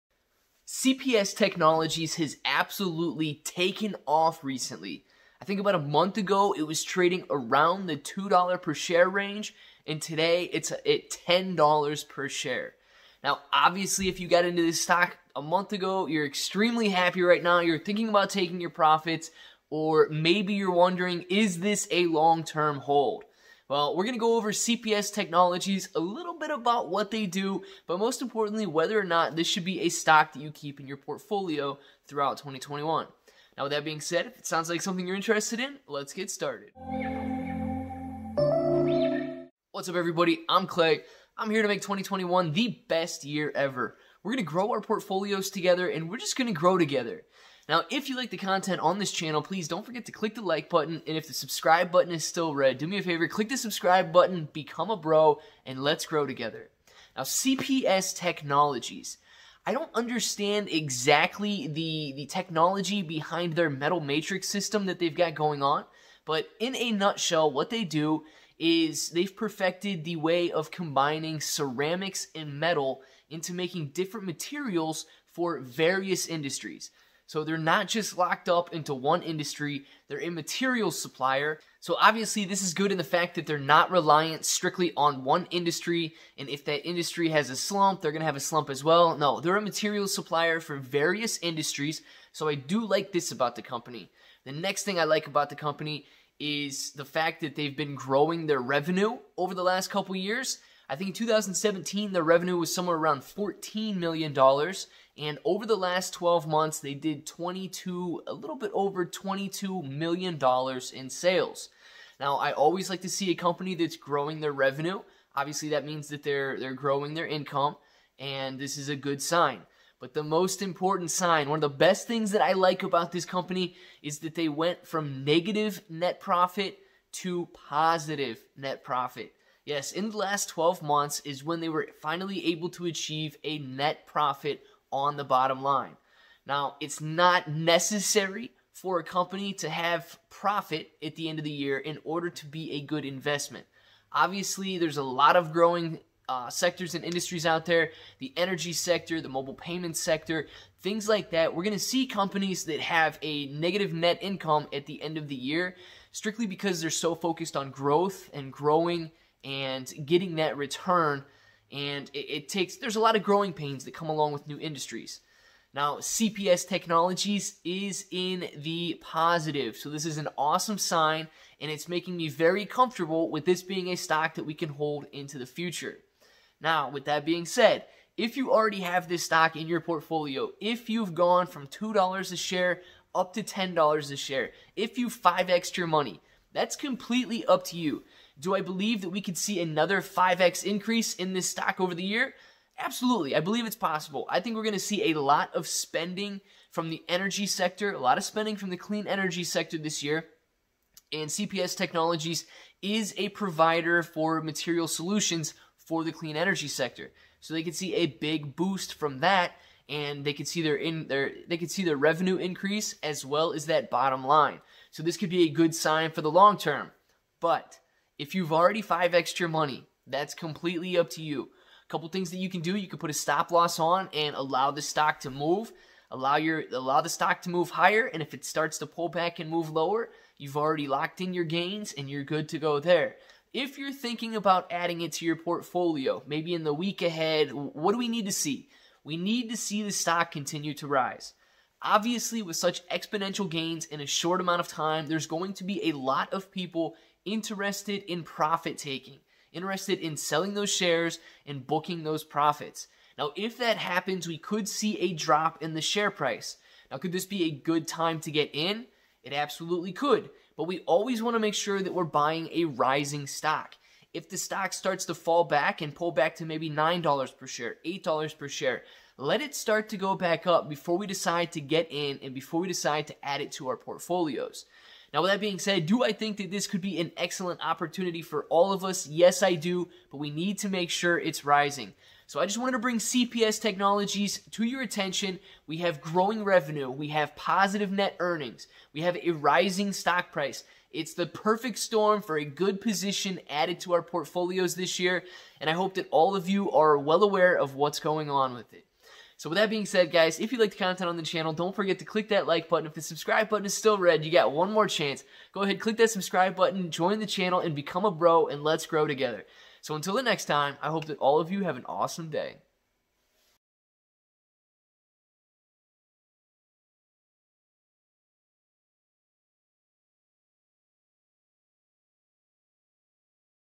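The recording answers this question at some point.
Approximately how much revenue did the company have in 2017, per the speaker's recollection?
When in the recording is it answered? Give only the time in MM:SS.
01:43.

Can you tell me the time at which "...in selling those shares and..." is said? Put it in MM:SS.
04:09.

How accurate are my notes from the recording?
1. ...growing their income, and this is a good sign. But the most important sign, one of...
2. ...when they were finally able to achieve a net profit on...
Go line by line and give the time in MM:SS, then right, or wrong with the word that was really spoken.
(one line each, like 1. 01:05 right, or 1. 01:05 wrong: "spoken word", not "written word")
1. 01:56 right
2. 02:11 right.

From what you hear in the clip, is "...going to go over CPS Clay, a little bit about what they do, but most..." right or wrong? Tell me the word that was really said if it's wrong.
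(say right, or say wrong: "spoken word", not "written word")
wrong: "Technologies", not "Clay".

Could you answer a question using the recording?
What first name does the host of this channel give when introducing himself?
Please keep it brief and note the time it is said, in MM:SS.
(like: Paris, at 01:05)
Clay, at 00:40.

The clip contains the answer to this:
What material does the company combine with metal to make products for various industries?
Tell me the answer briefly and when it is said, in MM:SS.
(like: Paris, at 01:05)
Ceramics, at 01:11.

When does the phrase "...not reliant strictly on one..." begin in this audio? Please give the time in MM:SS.
01:23.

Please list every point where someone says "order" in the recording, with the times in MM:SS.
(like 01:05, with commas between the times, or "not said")
02:22.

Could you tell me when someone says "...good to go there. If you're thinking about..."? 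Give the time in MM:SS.
03:52.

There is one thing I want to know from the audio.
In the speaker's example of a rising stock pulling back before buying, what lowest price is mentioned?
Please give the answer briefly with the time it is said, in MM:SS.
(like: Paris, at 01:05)
$8, at 04:27.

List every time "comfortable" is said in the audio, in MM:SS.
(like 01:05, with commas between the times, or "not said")
02:52.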